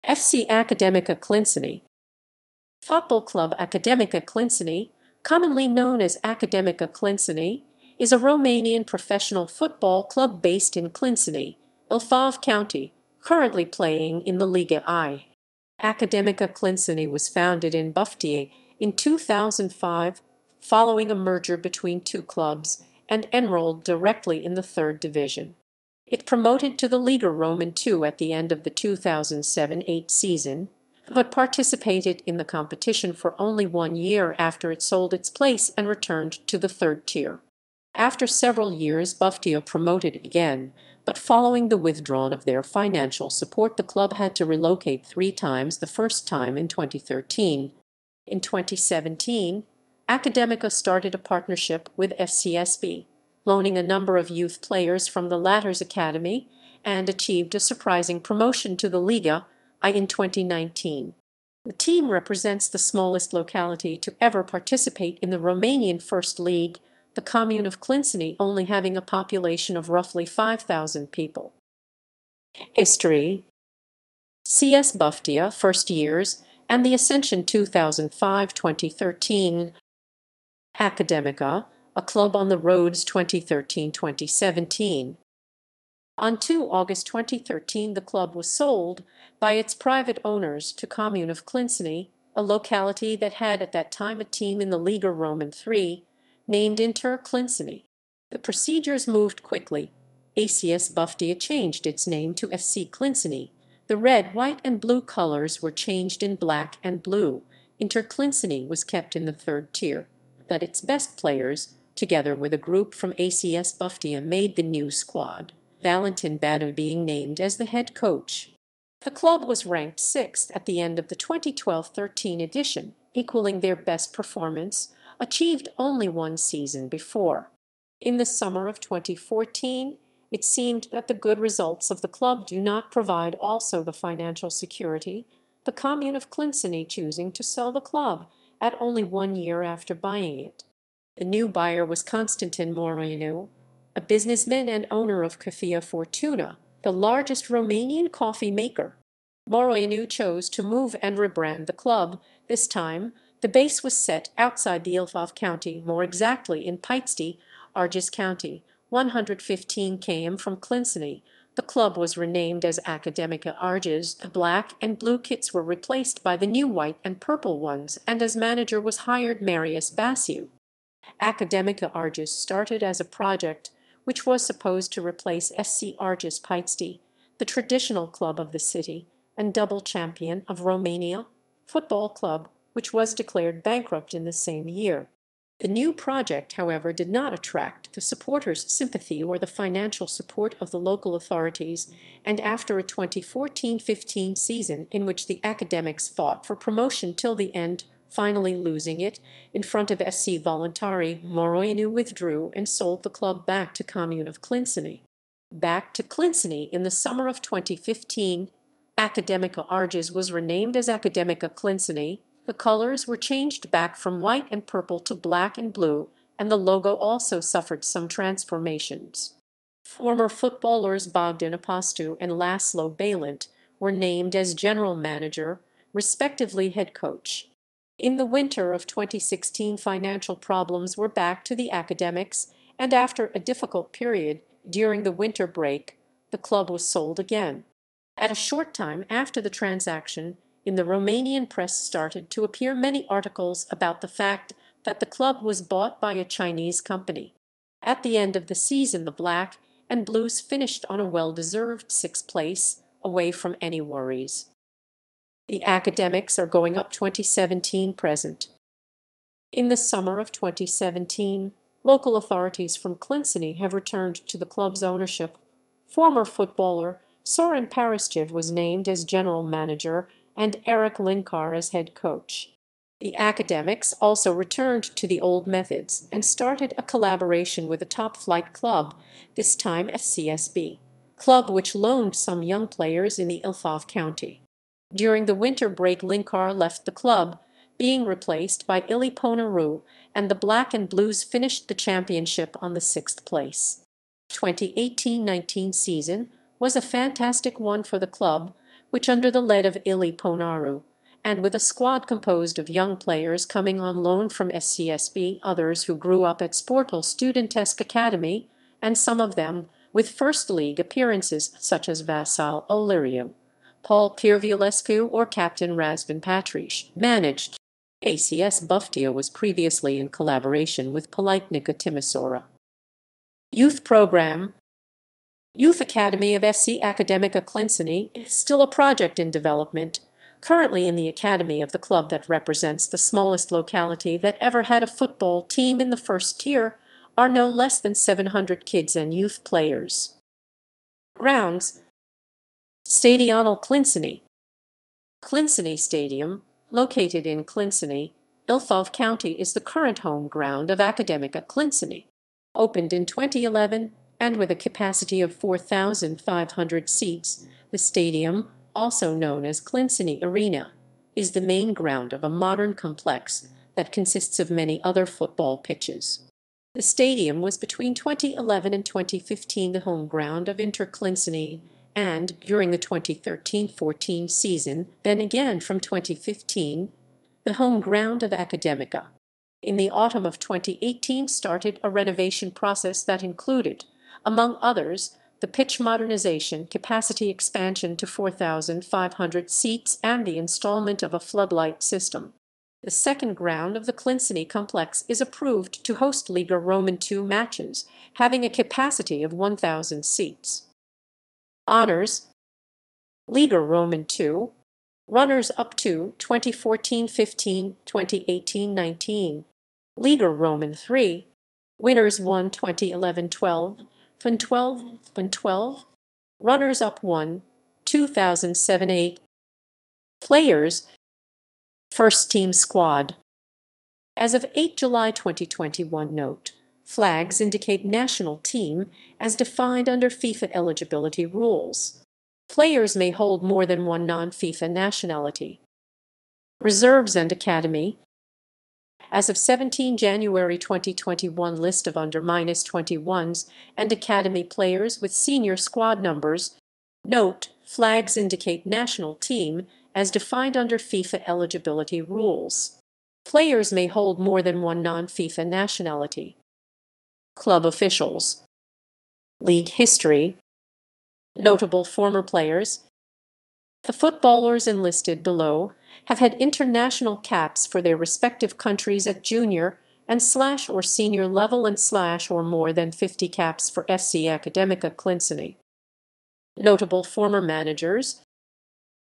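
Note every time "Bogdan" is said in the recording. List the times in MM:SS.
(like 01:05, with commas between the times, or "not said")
03:41.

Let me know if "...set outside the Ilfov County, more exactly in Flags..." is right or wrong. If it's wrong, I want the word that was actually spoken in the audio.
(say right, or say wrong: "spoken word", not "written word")
wrong: "Pitești", not "Flags".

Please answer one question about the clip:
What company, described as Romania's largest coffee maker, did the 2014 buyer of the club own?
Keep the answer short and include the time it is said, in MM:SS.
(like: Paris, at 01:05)
Cafea Fortuna, at 02:25.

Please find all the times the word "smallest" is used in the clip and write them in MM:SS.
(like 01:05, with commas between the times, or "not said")
01:02, 05:32.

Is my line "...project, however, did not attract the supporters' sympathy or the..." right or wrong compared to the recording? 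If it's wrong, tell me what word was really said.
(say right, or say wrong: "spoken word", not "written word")
right.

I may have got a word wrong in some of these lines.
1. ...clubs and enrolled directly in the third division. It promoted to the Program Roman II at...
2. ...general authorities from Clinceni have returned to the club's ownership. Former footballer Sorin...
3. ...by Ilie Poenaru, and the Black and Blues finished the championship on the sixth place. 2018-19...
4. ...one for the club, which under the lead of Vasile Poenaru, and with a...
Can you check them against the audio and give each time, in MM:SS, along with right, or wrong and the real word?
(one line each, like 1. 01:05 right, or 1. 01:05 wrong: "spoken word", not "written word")
1. 00:22 wrong: "Liga", not "Program"
2. 04:21 wrong: "local", not "general"
3. 04:48 right
4. 04:57 wrong: "Ilie", not "Vasile".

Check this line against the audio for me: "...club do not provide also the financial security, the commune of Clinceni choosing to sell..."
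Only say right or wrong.
right.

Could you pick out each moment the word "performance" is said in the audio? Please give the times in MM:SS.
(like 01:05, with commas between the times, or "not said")
02:04.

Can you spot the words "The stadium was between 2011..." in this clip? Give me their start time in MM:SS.
06:06.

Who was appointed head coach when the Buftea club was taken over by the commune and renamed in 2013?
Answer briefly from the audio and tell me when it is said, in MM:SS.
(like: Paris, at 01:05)
Valentin Badea, at 01:55.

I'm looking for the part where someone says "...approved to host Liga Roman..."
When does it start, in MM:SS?
06:35.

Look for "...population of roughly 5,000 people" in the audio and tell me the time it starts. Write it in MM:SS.
01:09.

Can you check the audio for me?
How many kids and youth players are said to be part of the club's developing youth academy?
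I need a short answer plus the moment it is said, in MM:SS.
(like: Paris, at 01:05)
700, at 05:37.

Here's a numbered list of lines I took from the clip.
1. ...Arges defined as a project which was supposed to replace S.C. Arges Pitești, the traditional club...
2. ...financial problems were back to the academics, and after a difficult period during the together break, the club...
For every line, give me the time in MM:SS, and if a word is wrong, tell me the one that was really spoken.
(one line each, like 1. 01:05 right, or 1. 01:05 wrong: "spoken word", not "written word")
1. 02:51 wrong: "started", not "defined"
2. 03:49 wrong: "winter", not "together".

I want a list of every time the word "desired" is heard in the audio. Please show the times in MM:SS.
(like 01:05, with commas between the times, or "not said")
not said.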